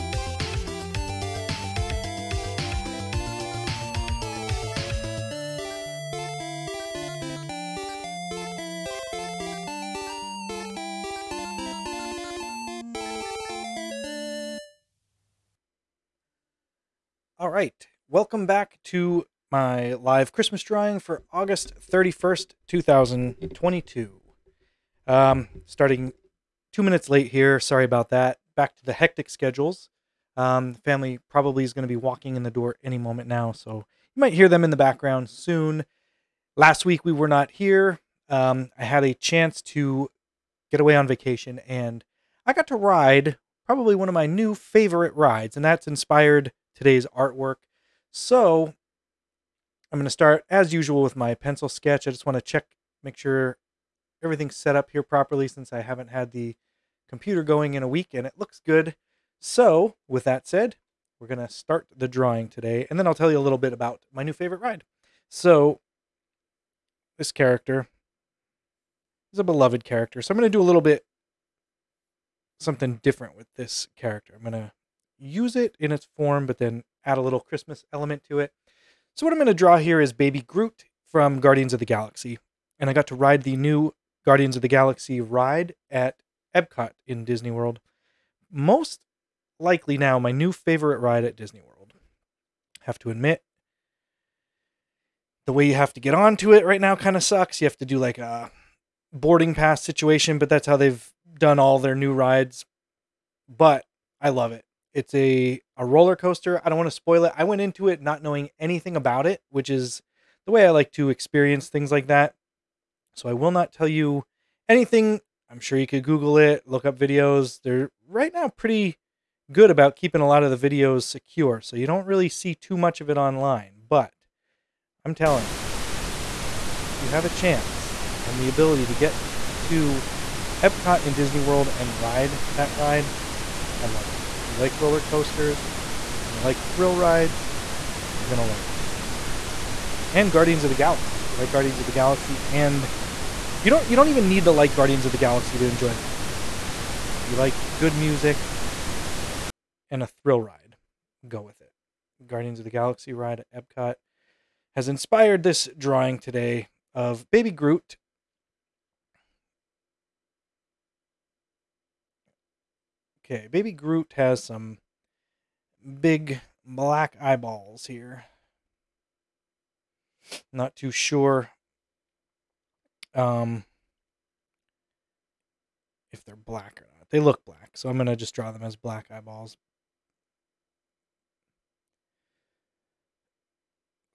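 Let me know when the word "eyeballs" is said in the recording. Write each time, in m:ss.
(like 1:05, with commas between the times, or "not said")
2:47, 2:59.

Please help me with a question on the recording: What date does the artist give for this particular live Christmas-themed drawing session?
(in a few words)
August 31st, 2022.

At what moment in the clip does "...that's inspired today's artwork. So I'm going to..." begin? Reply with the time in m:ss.
0:45.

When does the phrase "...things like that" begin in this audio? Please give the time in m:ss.
1:51.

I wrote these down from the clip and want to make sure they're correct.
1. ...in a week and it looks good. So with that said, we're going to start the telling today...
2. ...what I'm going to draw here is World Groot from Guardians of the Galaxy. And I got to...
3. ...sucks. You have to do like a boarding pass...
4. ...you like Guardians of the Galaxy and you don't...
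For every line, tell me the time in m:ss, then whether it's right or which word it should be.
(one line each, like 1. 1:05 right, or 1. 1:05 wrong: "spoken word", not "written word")
1. 0:57 wrong: "drawing", not "telling"
2. 1:19 wrong: "Baby", not "World"
3. 1:37 right
4. 2:21 right.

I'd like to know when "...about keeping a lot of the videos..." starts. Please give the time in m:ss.
1:59.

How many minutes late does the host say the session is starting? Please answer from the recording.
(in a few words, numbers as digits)
2.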